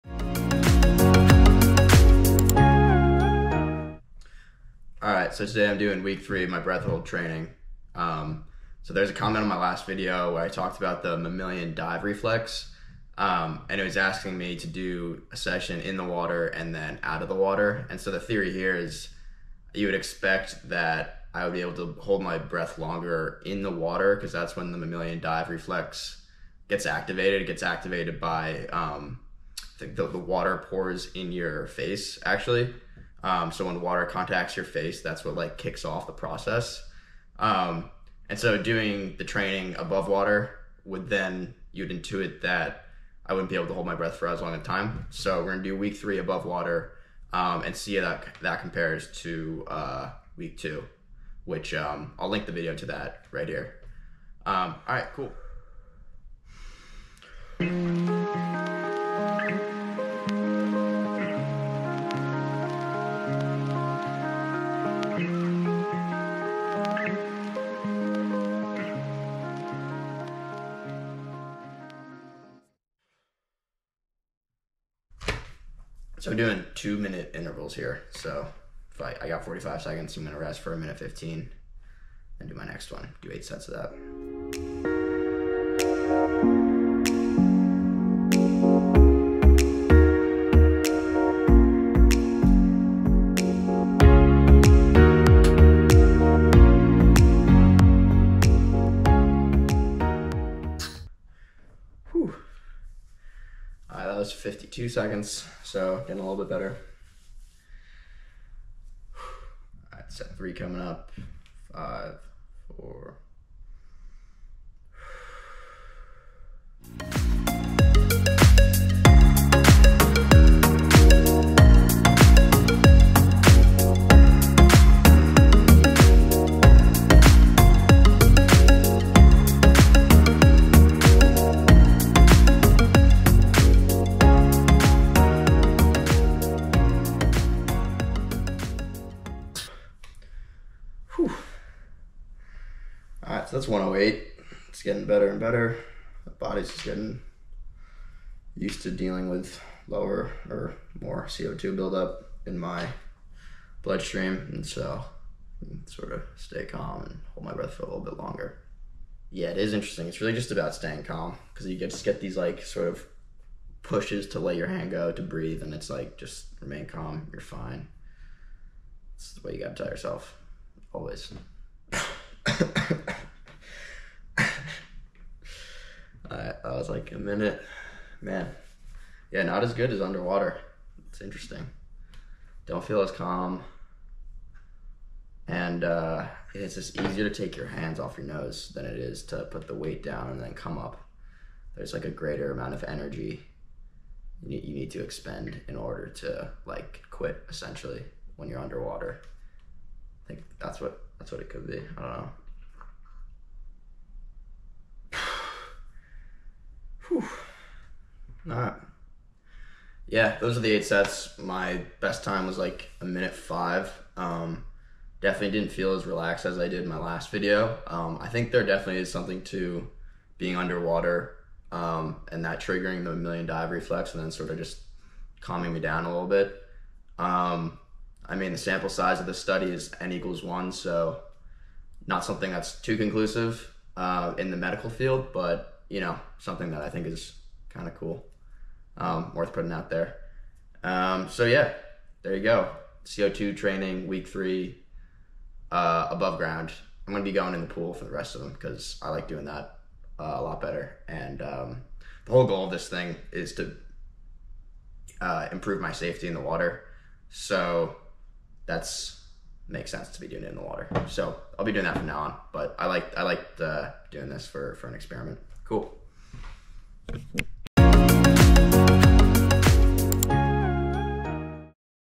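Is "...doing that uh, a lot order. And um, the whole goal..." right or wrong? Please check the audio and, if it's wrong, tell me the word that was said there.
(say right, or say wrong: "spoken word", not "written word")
wrong: "better", not "order".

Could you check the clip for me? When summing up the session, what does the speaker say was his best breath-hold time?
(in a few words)
1 minute 5 seconds.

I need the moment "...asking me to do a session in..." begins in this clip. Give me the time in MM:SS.
00:13.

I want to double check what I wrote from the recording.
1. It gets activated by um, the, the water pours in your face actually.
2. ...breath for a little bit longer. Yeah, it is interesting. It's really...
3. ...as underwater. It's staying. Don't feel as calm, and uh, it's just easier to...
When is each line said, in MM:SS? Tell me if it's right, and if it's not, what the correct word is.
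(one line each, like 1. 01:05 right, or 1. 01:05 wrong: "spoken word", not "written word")
1. 00:27 right
2. 02:37 right
3. 02:59 wrong: "interesting", not "staying".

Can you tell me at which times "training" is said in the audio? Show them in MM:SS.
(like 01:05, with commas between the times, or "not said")
00:07, 00:39, 04:03.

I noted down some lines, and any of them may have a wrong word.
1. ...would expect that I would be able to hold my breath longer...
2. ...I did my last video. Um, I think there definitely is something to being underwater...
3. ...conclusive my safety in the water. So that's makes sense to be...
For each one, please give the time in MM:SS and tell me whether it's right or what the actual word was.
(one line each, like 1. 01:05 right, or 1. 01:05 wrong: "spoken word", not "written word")
1. 00:19 right
2. 03:36 right
3. 04:15 wrong: "improve", not "conclusive".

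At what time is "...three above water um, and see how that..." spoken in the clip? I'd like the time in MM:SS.
00:45.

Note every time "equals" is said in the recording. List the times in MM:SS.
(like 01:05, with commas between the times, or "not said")
03:50.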